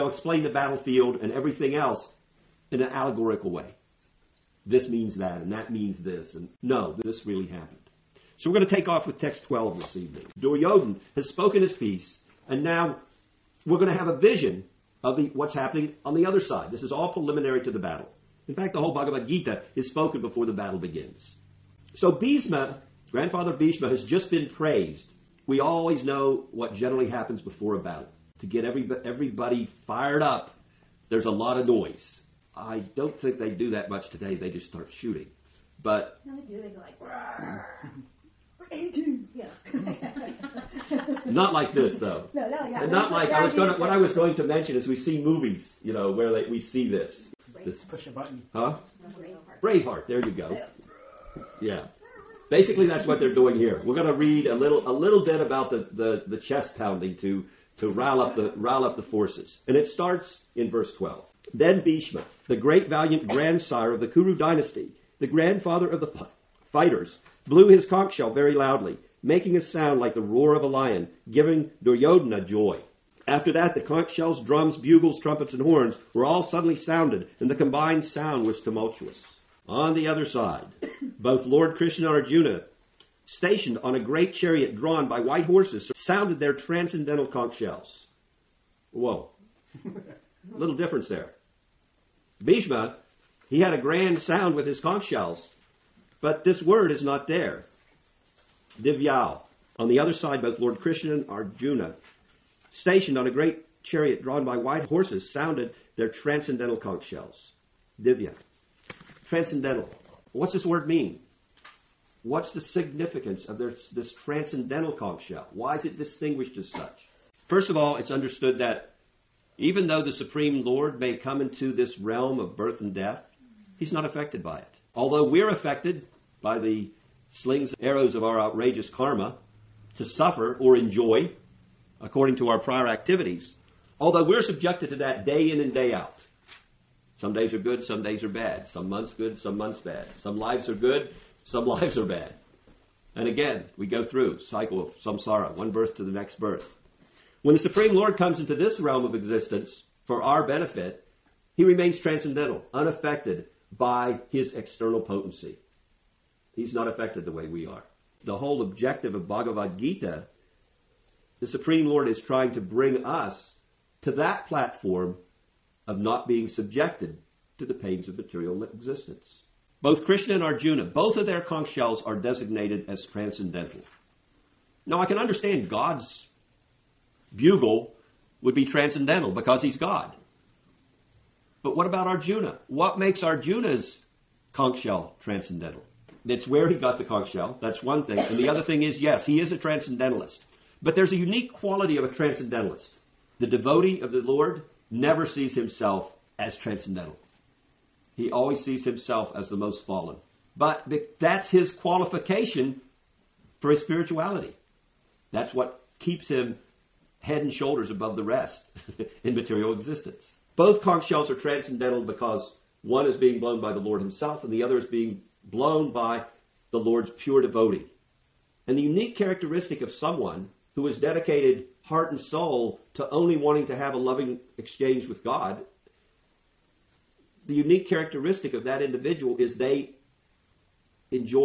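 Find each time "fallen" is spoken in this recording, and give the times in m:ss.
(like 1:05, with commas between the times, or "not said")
3:19.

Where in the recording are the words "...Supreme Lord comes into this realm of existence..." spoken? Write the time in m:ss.
2:27.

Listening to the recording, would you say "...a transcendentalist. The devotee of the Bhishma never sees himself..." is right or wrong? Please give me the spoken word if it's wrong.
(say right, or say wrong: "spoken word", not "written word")
wrong: "Lord", not "Bhishma".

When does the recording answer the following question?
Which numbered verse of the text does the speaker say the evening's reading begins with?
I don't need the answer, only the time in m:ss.
0:09.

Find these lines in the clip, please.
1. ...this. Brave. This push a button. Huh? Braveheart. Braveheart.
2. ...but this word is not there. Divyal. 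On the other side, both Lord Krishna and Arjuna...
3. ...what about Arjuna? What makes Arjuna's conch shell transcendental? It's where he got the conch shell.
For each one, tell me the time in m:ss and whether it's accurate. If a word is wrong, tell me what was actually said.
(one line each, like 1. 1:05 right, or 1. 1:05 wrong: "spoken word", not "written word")
1. 0:46 right
2. 1:36 right
3. 3:01 right.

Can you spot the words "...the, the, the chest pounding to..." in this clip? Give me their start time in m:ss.
0:55.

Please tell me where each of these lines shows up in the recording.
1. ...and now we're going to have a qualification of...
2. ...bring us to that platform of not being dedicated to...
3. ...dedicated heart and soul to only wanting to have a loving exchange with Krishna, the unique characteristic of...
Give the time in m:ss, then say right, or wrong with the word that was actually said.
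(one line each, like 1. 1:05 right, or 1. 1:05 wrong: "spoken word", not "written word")
1. 0:12 wrong: "vision", not "qualification"
2. 2:42 wrong: "subjected", not "dedicated"
3. 3:40 wrong: "God", not "Krishna".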